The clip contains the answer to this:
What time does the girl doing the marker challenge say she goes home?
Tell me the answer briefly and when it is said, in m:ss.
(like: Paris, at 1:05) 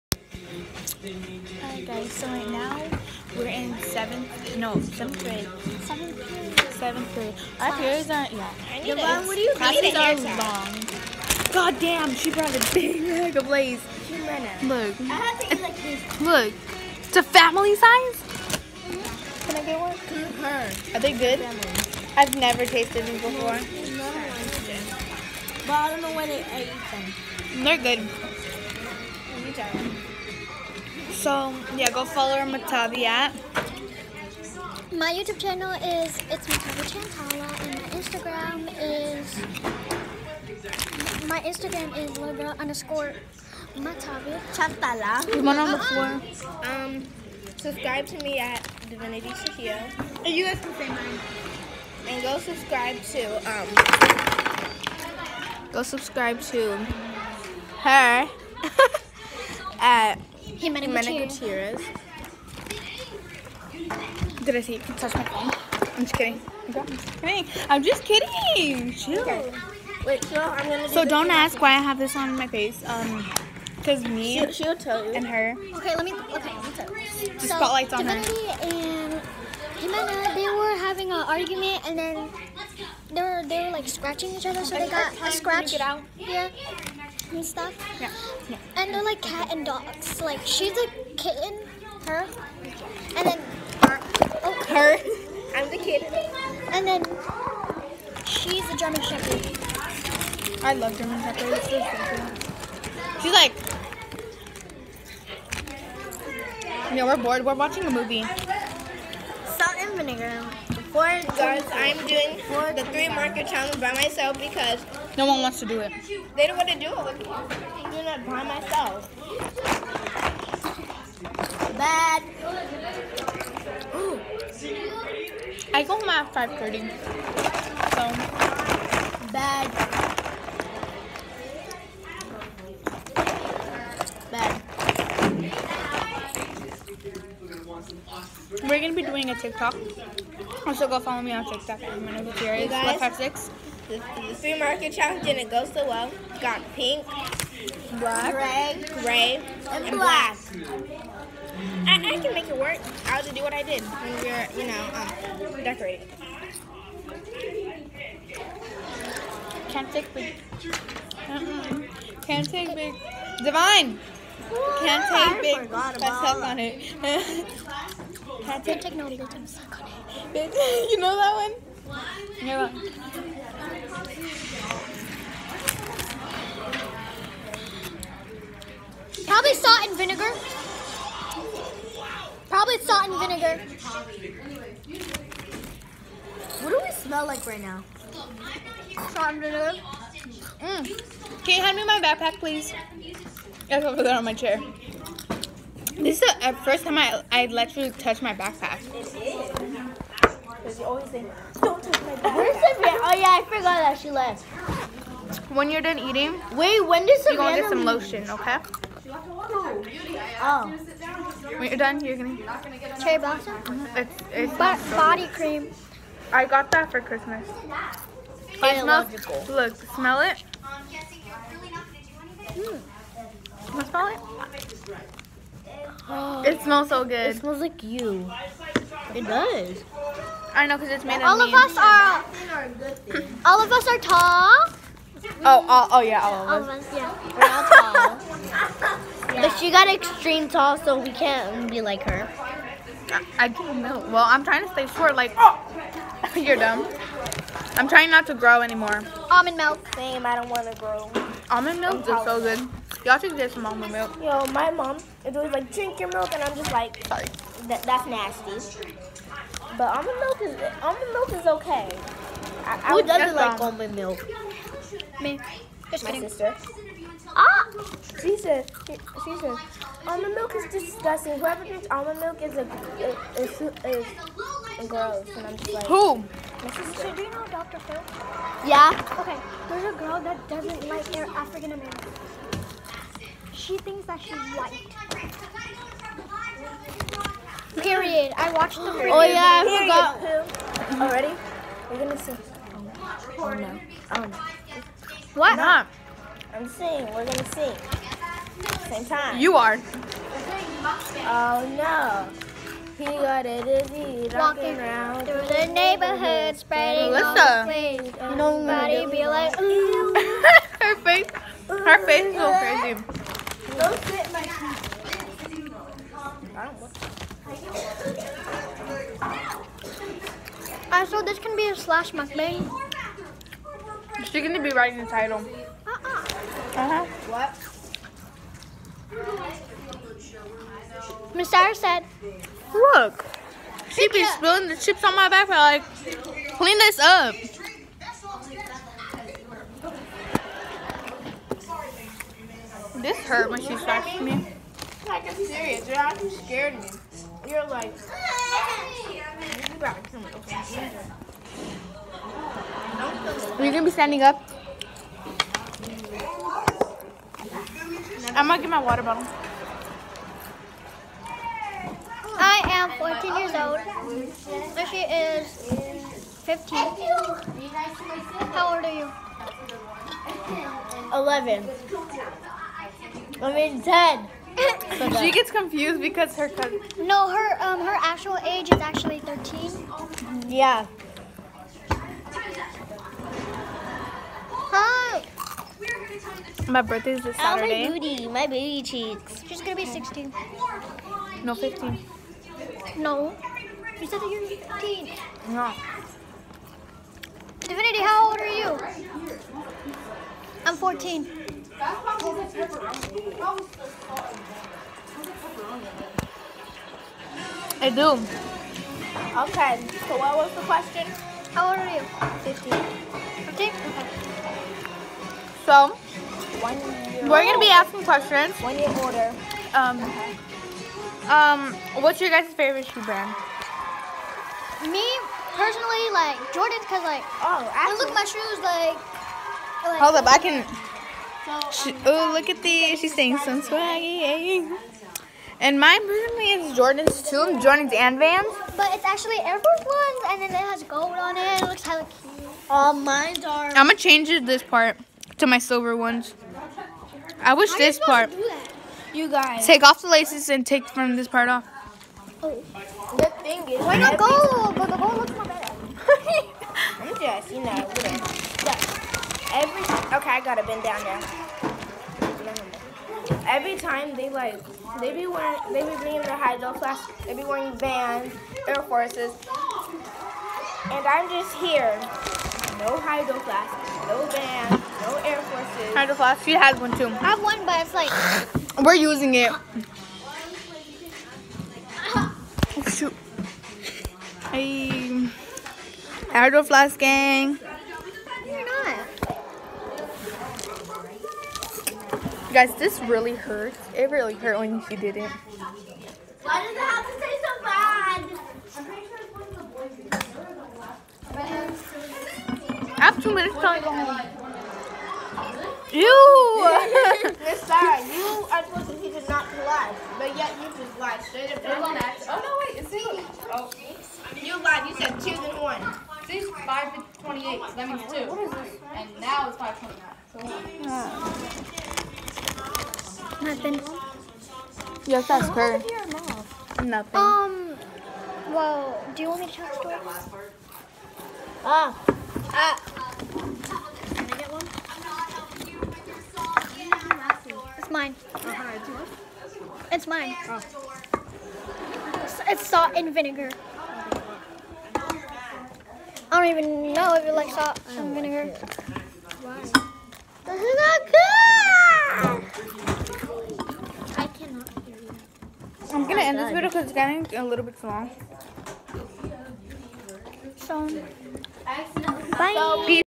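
5:30, at 2:06.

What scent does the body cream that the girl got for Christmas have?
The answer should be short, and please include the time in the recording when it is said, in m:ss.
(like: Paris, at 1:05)
Cherry blossom, at 3:33.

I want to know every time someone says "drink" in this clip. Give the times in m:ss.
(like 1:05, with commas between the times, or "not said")
4:15, 4:31.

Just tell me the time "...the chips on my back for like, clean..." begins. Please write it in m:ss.
5:34.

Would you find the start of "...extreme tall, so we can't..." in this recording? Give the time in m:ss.
3:59.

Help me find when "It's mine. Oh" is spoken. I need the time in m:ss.
9:00.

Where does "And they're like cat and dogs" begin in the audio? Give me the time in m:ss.
1:28.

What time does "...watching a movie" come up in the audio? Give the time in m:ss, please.
1:47.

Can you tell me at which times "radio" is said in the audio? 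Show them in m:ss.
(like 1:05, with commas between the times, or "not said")
not said.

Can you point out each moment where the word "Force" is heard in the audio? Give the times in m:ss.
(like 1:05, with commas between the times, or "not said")
7:19, 7:48.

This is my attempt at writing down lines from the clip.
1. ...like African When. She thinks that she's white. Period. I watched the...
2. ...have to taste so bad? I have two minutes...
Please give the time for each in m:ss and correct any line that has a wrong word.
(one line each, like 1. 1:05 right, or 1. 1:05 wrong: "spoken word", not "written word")
1. 4:40 wrong: "Americans", not "When"
2. 8:17 right.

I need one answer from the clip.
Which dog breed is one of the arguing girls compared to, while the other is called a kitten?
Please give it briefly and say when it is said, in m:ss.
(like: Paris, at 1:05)
German Shepherd, at 1:38.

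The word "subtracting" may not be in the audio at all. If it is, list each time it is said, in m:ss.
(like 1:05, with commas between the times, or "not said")
not said.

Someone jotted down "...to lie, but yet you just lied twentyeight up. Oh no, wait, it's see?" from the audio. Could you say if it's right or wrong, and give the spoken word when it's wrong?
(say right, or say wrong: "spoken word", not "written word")
wrong: "straight", not "twentyeight".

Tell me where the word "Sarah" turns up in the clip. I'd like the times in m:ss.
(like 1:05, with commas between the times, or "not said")
5:31, 8:27.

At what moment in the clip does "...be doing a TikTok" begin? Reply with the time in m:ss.
2:18.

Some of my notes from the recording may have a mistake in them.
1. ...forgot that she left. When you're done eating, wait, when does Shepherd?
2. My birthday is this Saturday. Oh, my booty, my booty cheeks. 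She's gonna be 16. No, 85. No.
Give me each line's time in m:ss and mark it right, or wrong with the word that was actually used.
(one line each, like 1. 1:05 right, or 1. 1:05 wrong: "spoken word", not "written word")
1. 3:23 wrong: "Savannah", not "Shepherd"
2. 6:26 wrong: "15", not "85".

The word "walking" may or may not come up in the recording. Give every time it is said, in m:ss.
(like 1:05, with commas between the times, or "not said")
5:04.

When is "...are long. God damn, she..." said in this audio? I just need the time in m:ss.
0:09.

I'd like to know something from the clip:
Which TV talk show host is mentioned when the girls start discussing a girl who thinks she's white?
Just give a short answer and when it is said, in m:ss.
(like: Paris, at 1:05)
Dr. Phil, at 4:37.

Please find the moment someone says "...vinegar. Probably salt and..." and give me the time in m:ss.
2:59.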